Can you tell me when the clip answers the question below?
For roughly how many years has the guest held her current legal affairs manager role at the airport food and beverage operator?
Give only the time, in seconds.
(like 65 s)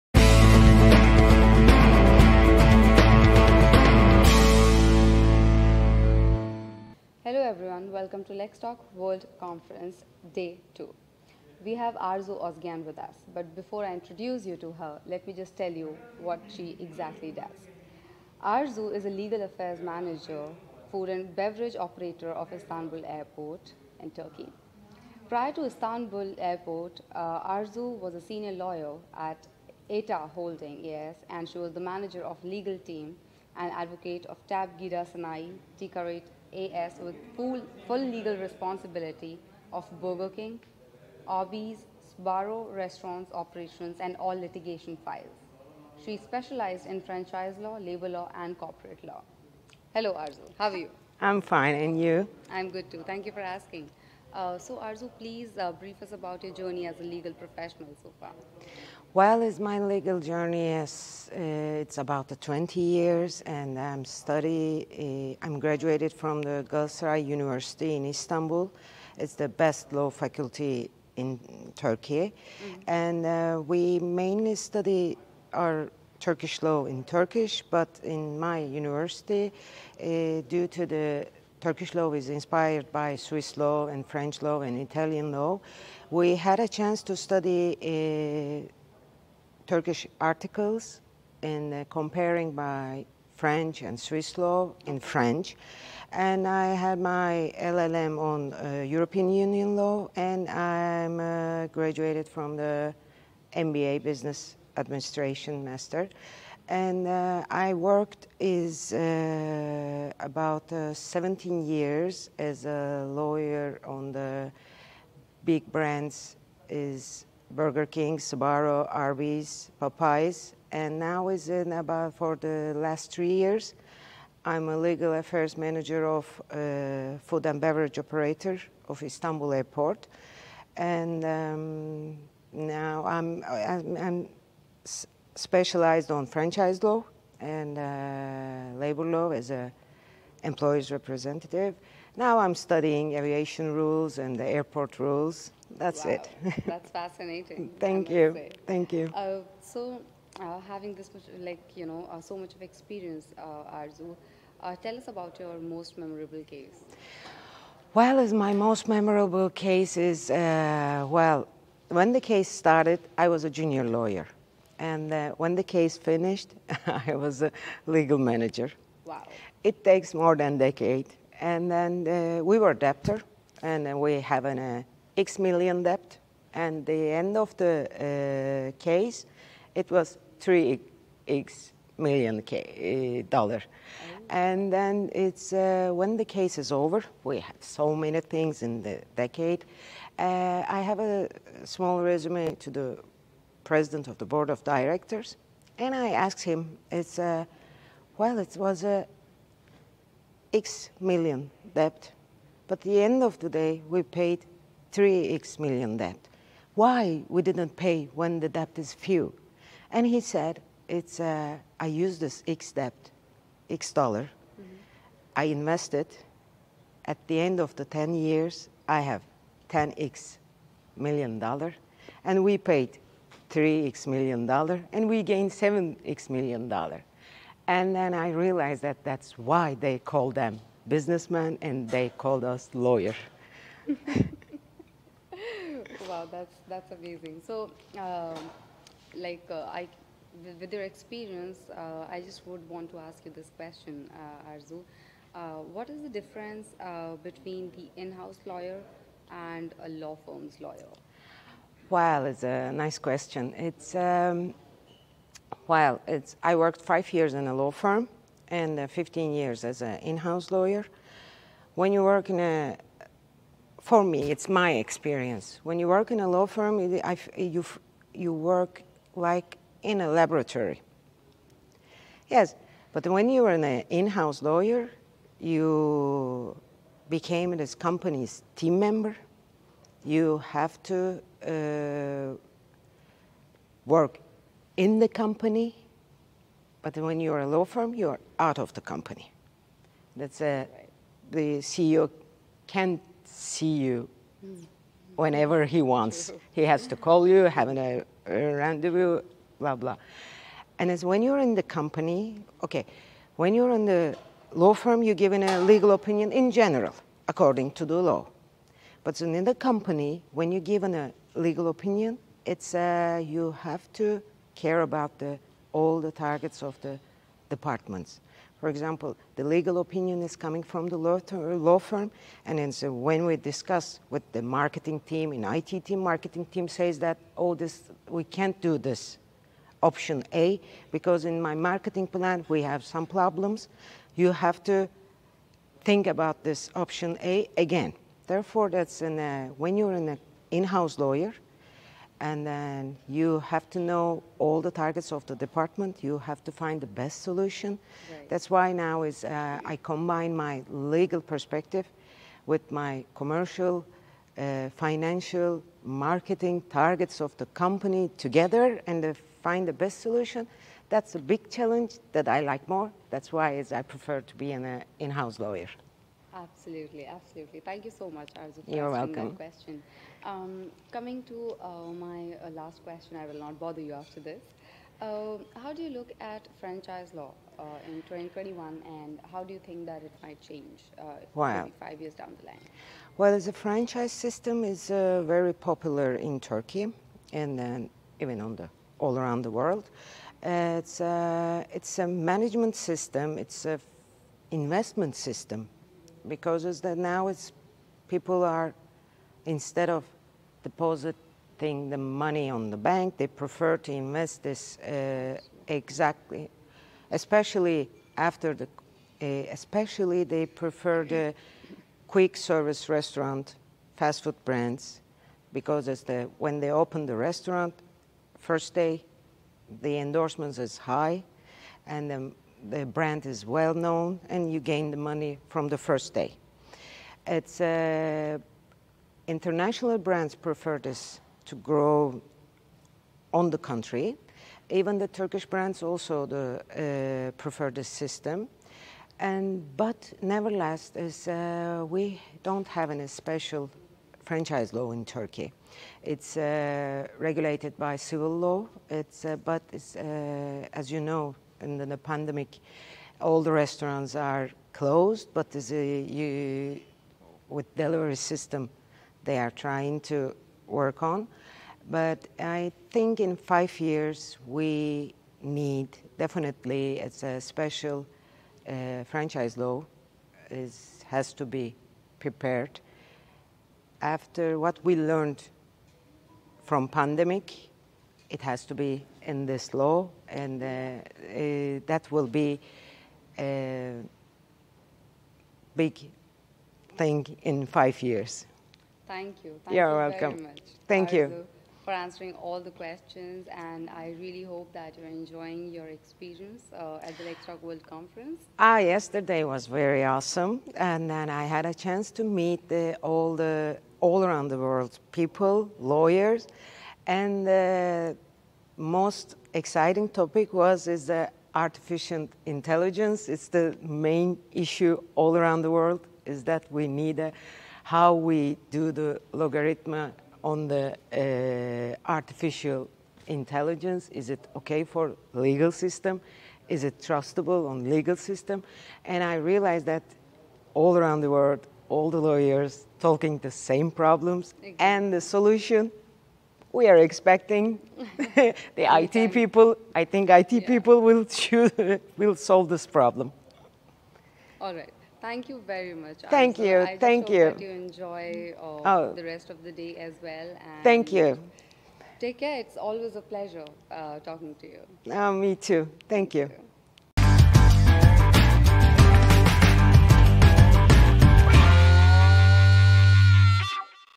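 123 s.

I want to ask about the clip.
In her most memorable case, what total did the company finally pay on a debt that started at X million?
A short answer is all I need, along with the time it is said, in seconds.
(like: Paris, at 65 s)
3X million dollars, at 180 s.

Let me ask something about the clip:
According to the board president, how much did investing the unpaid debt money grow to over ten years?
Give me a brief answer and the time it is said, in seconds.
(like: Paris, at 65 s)
10X million dollars, at 219 s.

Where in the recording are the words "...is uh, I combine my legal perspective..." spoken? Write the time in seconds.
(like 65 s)
349 s.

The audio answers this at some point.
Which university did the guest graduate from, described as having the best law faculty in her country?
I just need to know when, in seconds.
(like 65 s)
66 s.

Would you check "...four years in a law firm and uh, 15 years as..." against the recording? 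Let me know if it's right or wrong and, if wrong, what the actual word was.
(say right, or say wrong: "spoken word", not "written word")
wrong: "five", not "four".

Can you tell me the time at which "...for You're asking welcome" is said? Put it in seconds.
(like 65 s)
368 s.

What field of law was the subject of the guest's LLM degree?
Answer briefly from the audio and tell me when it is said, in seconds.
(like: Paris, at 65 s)
European Union law, at 98 s.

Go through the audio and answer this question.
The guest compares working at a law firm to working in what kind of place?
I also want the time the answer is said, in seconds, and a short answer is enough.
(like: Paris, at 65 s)
A laboratory, at 270 s.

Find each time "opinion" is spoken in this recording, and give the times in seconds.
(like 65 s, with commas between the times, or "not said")
305 s, 311 s, 319 s.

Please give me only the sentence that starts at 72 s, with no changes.
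and uh, we mainly study our Turkish law in Turkish.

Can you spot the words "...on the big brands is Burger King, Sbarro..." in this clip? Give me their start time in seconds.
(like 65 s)
113 s.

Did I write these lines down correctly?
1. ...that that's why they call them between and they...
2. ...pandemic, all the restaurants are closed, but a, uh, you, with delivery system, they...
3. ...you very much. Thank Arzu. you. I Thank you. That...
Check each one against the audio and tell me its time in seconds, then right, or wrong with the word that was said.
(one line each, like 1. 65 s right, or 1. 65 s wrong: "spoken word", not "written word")
1. 228 s wrong: "businessmen", not "between"
2. 451 s right
3. 545 s right.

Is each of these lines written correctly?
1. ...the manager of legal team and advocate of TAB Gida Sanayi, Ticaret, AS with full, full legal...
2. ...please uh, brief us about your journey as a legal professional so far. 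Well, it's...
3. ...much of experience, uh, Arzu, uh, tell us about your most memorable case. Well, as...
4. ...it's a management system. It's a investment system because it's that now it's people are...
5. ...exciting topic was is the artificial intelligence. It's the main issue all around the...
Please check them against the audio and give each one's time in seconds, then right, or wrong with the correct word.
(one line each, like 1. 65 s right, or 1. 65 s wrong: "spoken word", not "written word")
1. 31 s right
2. 55 s right
3. 152 s right
4. 391 s right
5. 509 s right.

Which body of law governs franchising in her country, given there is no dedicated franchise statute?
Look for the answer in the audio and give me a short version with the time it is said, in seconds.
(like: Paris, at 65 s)
Civil law, at 447 s.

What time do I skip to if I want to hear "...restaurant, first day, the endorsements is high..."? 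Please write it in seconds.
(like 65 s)
417 s.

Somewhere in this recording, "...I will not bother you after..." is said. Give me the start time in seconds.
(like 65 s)
373 s.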